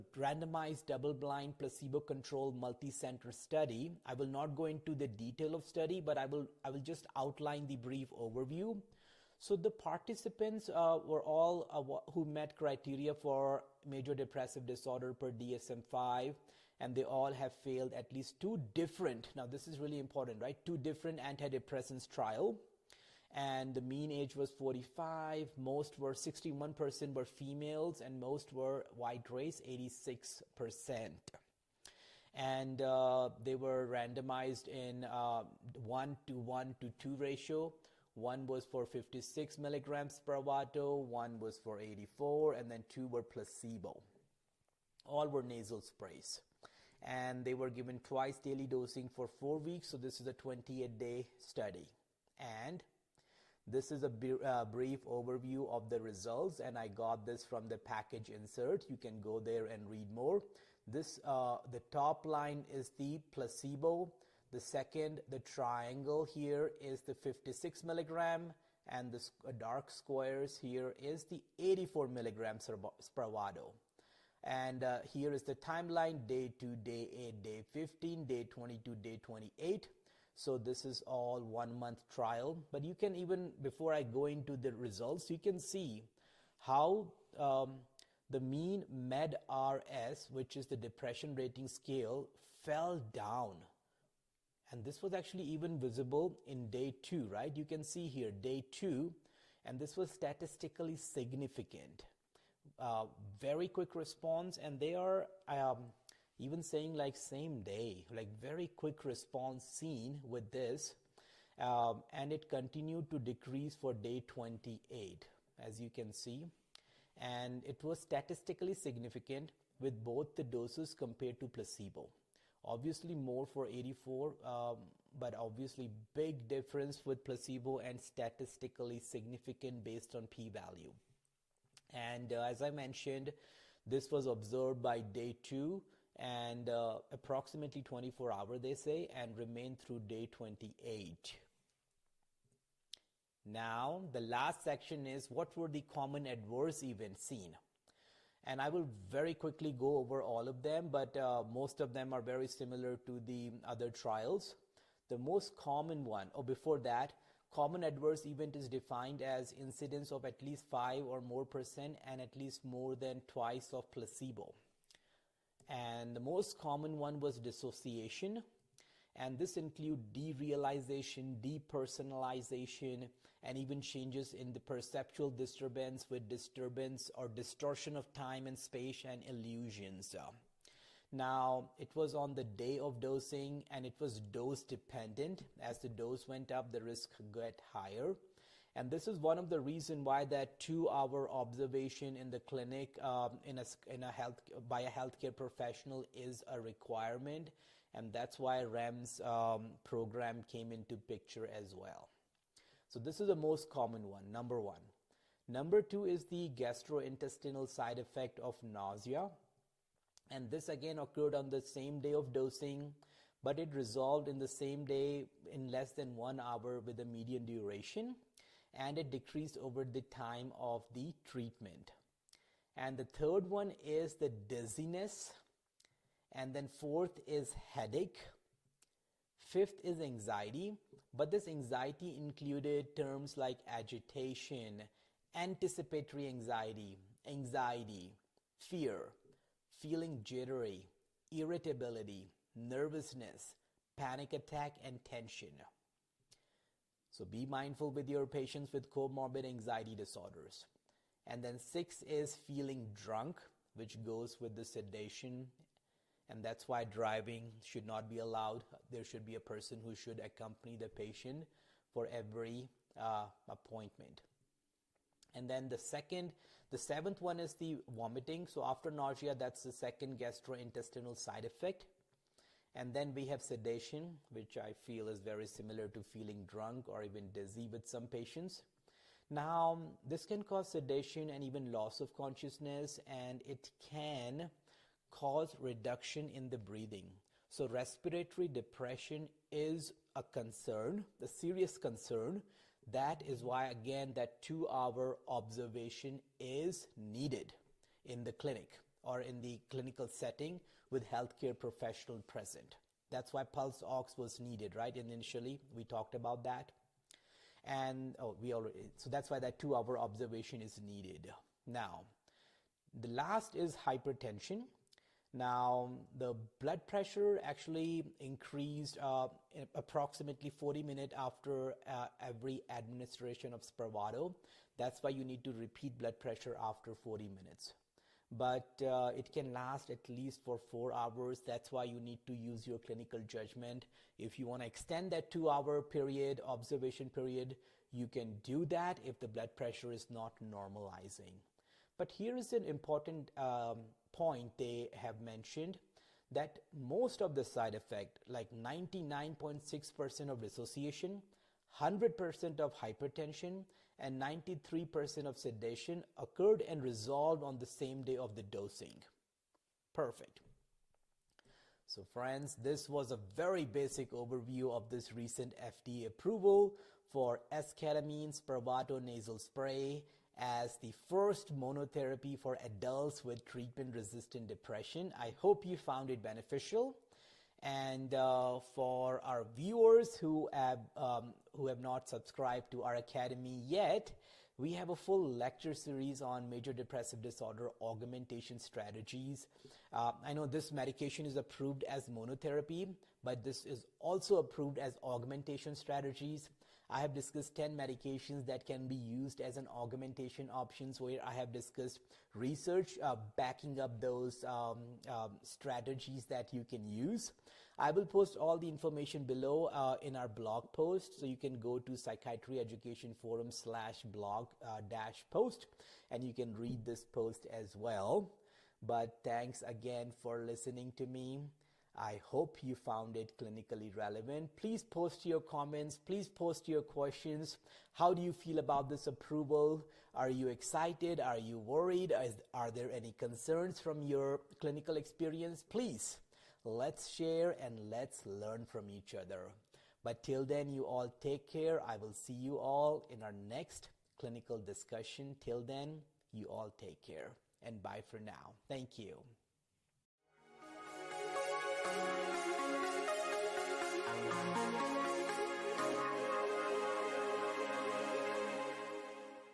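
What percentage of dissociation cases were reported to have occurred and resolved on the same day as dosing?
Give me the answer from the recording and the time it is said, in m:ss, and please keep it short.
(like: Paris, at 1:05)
99.6%, at 5:48.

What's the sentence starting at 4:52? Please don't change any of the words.
That is why, again, that two hour observation is needed in the clinic or in the clinical setting with healthcare professional present.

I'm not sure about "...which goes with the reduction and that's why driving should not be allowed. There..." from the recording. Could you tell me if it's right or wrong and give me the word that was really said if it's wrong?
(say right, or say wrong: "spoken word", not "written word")
wrong: "sedation", not "reduction".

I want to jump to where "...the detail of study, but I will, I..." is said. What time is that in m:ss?
0:04.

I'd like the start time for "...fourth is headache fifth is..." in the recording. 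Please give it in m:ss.
3:46.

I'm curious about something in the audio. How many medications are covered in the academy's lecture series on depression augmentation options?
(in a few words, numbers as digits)
10.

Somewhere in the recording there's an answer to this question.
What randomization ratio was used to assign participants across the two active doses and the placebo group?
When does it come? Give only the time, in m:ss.
0:35.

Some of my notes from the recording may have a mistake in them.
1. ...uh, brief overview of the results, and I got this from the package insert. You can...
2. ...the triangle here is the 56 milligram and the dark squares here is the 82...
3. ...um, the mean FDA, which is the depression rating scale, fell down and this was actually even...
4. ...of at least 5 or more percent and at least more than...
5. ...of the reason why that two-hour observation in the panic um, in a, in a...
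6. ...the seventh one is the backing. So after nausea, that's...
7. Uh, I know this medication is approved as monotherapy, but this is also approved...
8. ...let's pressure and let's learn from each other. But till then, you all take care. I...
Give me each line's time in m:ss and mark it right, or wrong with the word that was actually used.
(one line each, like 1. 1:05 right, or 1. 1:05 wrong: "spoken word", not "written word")
1. 0:54 right
2. 1:05 wrong: "84", not "82"
3. 1:27 wrong: "MADRS", not "FDA"
4. 2:40 right
5. 3:09 wrong: "clinic", not "panic"
6. 4:26 wrong: "vomiting", not "backing"
7. 6:29 right
8. 7:16 wrong: "share", not "pressure".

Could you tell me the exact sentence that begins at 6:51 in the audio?
So you can go to psychiatry education forum slash blog uh, dash post and you can read this post as well.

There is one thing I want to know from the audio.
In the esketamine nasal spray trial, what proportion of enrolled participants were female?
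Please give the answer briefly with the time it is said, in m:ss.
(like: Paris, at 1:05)
61%, at 0:26.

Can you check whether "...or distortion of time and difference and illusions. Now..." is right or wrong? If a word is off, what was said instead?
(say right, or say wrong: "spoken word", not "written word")
wrong: "space", not "difference".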